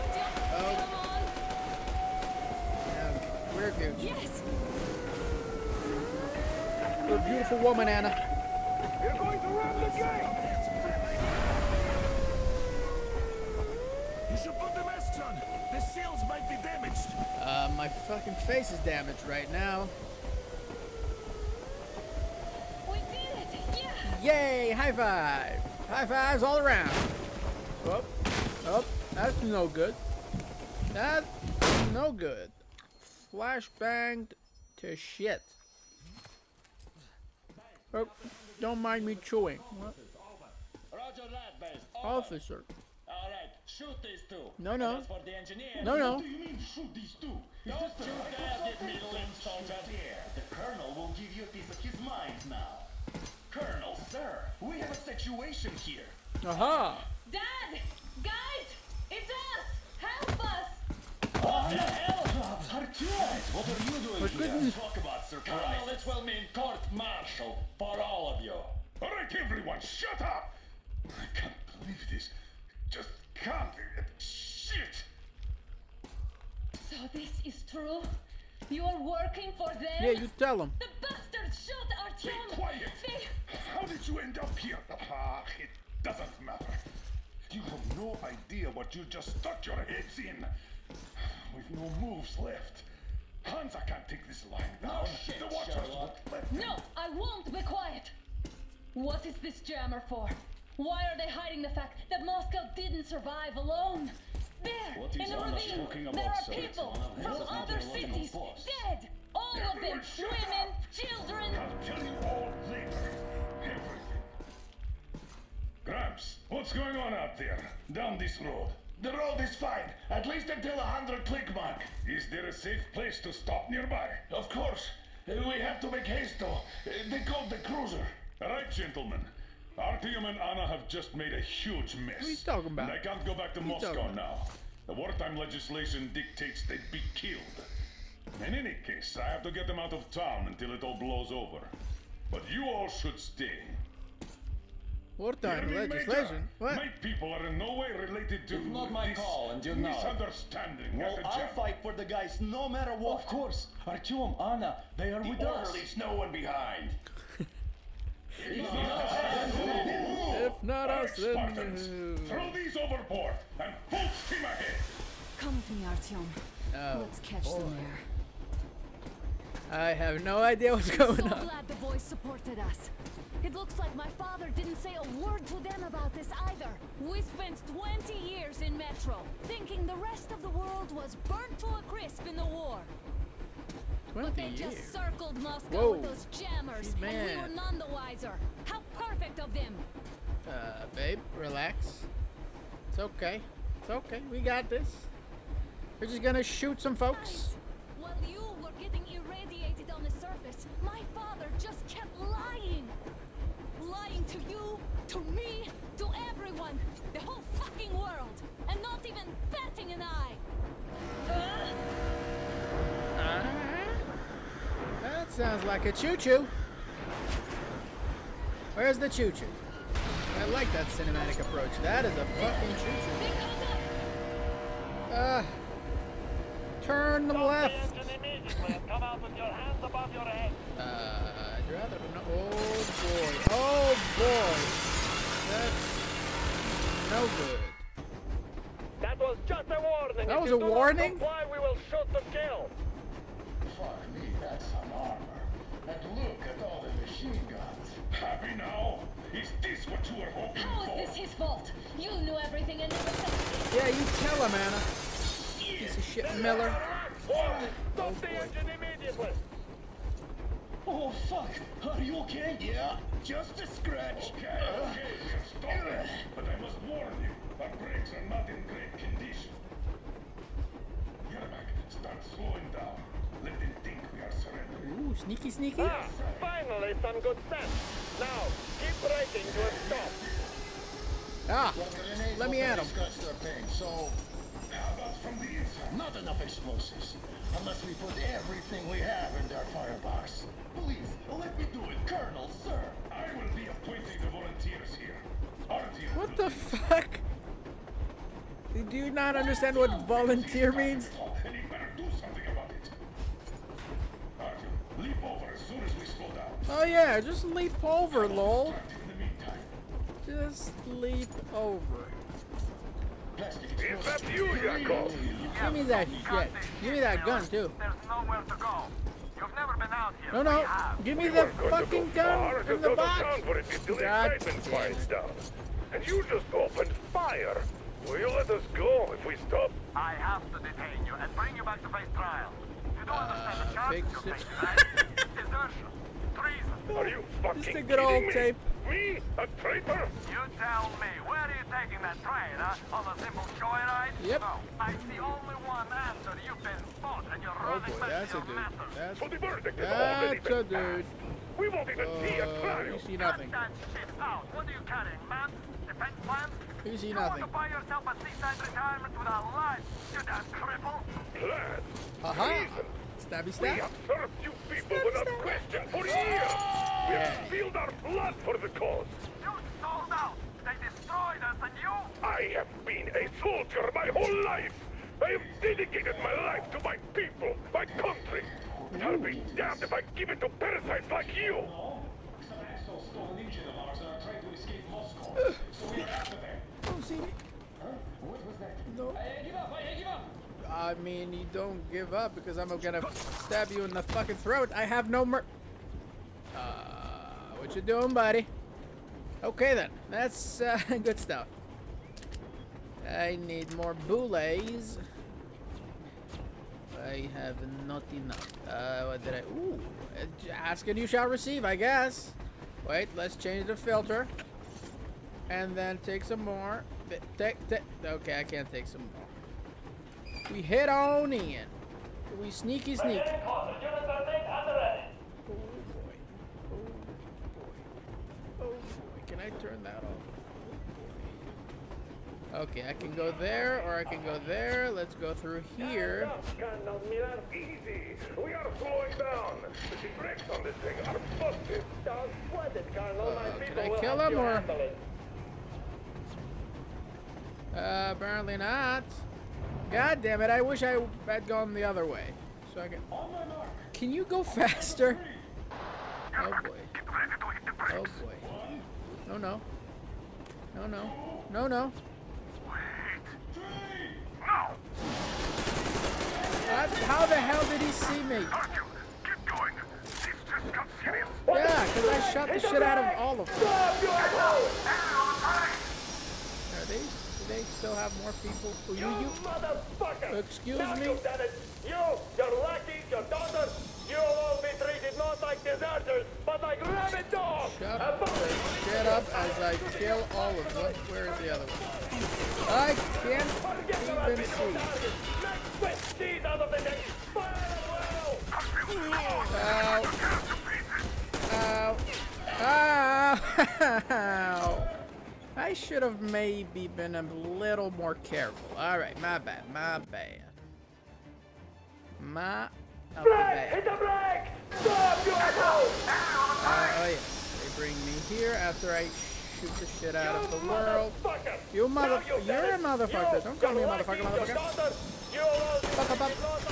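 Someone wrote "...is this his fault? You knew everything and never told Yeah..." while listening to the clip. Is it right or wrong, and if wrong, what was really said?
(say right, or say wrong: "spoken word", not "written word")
right.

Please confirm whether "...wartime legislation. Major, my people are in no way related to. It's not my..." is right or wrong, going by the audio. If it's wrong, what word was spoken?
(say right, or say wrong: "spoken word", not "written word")
right.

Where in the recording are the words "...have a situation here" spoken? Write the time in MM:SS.
00:54.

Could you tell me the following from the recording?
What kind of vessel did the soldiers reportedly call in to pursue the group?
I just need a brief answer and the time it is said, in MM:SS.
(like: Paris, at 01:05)
cruiser, at 02:07.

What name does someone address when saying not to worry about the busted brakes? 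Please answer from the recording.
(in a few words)
Carlo.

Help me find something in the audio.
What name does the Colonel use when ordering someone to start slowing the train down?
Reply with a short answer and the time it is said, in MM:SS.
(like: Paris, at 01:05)
Yermak, at 04:31.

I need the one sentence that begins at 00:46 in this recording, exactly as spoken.
What do you mean shoot these two?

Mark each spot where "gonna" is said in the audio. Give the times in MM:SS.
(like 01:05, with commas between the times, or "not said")
03:16, 06:32.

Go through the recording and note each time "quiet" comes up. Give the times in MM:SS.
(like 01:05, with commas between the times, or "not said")
01:22, 01:37.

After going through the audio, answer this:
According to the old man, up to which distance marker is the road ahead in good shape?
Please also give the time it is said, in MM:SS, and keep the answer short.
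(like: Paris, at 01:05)
100 click mark, at 02:00.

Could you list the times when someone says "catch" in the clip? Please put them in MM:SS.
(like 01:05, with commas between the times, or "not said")
02:47.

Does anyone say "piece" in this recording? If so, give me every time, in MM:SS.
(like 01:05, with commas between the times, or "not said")
00:51, 04:15.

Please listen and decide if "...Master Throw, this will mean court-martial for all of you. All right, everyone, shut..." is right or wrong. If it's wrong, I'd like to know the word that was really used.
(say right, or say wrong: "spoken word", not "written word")
wrong: "Colonel", not "Throw".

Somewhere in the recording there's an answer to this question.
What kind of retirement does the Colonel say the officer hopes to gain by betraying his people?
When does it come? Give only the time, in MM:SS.
05:58.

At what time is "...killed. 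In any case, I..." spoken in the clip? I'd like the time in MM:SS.
02:17.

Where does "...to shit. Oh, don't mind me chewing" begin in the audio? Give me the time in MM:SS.
00:34.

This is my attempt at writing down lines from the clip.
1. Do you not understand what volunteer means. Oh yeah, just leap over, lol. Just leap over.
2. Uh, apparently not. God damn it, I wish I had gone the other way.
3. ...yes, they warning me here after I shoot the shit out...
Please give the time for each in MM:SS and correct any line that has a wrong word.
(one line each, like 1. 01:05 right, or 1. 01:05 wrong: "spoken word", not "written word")
1. 04:58 right
2. 07:27 right
3. 08:37 wrong: "bring", not "warning".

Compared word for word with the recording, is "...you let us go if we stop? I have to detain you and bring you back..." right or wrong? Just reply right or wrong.
right.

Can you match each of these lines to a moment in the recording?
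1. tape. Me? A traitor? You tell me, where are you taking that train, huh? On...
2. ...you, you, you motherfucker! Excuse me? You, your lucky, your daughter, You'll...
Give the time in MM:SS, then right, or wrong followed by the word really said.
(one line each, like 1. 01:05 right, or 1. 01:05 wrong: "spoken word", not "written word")
1. 05:38 right
2. 07:58 right.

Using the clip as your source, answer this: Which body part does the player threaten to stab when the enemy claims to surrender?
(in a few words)
throat.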